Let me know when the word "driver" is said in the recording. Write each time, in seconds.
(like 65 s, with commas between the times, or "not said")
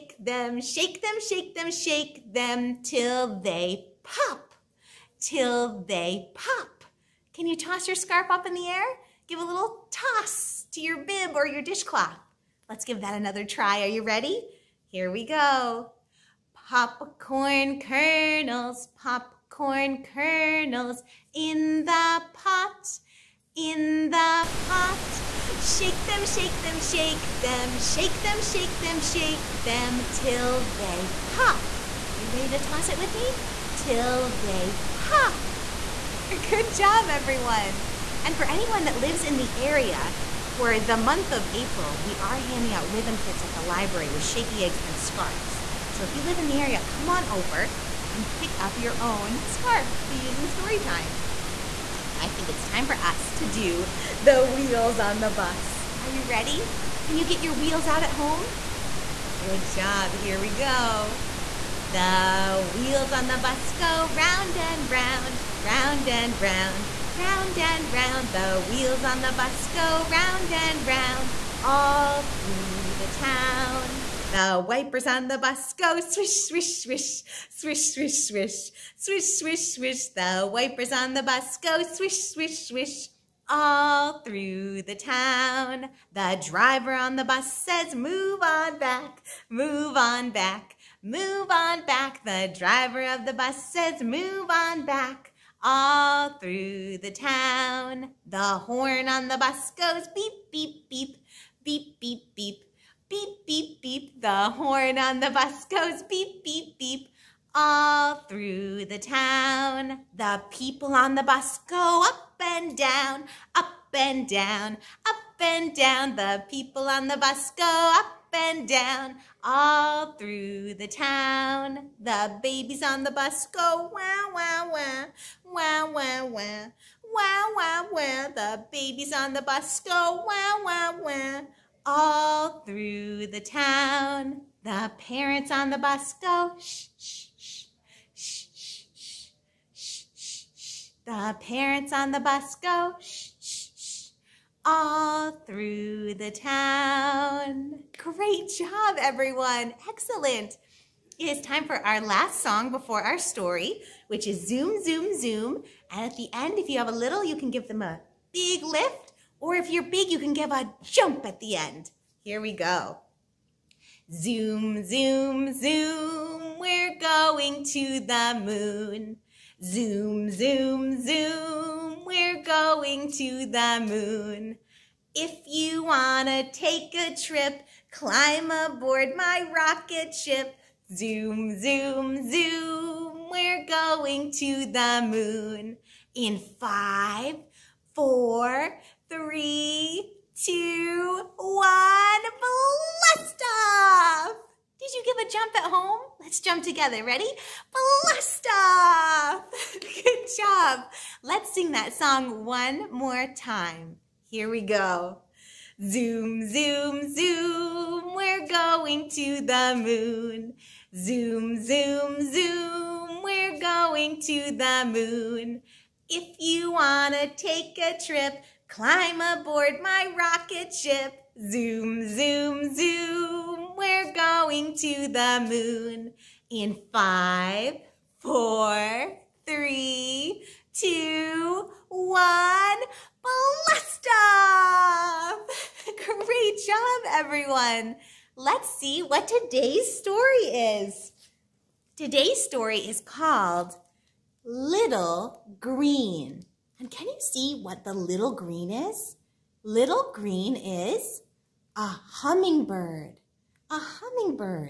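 86 s, 92 s.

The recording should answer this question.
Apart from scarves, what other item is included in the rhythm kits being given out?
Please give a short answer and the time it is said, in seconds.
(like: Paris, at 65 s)
Shaky eggs, at 44 s.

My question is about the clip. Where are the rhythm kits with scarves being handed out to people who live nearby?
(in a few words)
The library.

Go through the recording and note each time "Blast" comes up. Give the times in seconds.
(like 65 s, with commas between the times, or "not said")
192 s, 197 s, 233 s.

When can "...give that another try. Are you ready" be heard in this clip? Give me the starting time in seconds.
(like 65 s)
12 s.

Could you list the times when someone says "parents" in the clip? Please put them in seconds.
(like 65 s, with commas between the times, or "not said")
134 s, 141 s.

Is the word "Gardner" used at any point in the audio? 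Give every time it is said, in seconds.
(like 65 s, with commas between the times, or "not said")
not said.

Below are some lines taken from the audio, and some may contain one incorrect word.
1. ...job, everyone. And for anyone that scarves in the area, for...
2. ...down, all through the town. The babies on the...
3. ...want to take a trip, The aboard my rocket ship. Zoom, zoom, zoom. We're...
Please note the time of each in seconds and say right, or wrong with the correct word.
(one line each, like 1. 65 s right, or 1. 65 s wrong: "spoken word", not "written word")
1. 36 s wrong: "lives", not "scarves"
2. 118 s right
3. 216 s wrong: "Climb", not "The".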